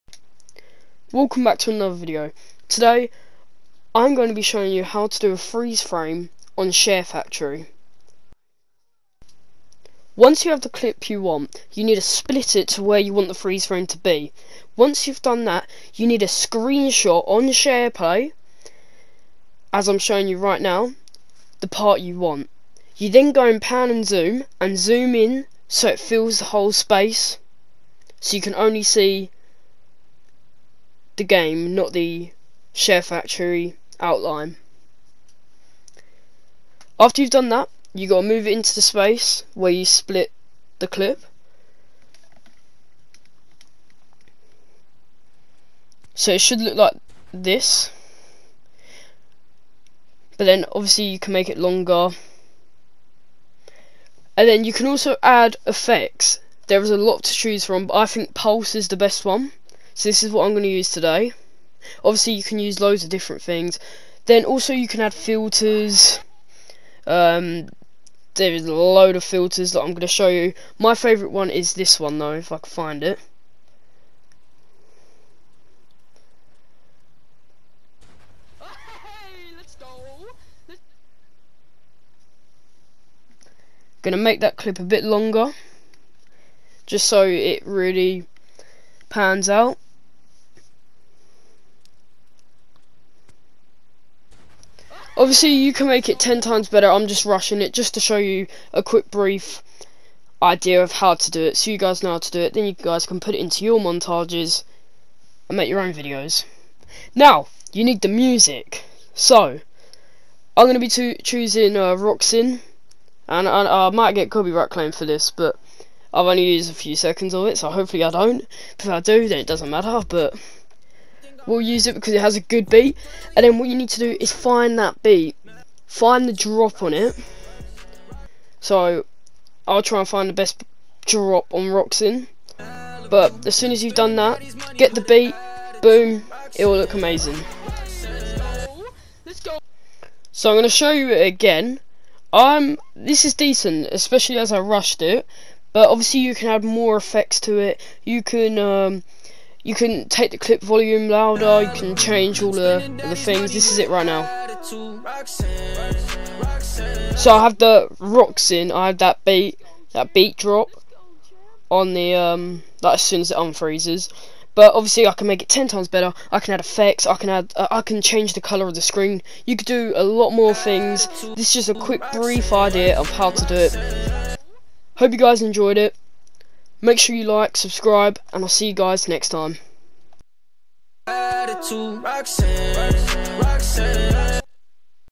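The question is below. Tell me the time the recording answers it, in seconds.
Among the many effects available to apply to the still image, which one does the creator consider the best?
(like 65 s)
58 s.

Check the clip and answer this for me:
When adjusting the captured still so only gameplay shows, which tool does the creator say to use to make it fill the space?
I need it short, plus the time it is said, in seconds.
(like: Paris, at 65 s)
pan and zoom, at 23 s.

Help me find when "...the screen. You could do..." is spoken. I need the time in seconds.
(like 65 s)
168 s.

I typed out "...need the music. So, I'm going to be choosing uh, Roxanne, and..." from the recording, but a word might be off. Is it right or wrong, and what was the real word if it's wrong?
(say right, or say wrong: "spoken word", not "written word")
right.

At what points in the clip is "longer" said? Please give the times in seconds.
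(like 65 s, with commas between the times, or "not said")
51 s, 85 s.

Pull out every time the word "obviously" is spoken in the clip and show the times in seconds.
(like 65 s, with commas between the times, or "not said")
50 s, 62 s, 95 s, 145 s, 164 s.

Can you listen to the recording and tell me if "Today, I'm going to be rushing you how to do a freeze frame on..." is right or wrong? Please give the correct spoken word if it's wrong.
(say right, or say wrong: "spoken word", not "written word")
wrong: "showing", not "rushing".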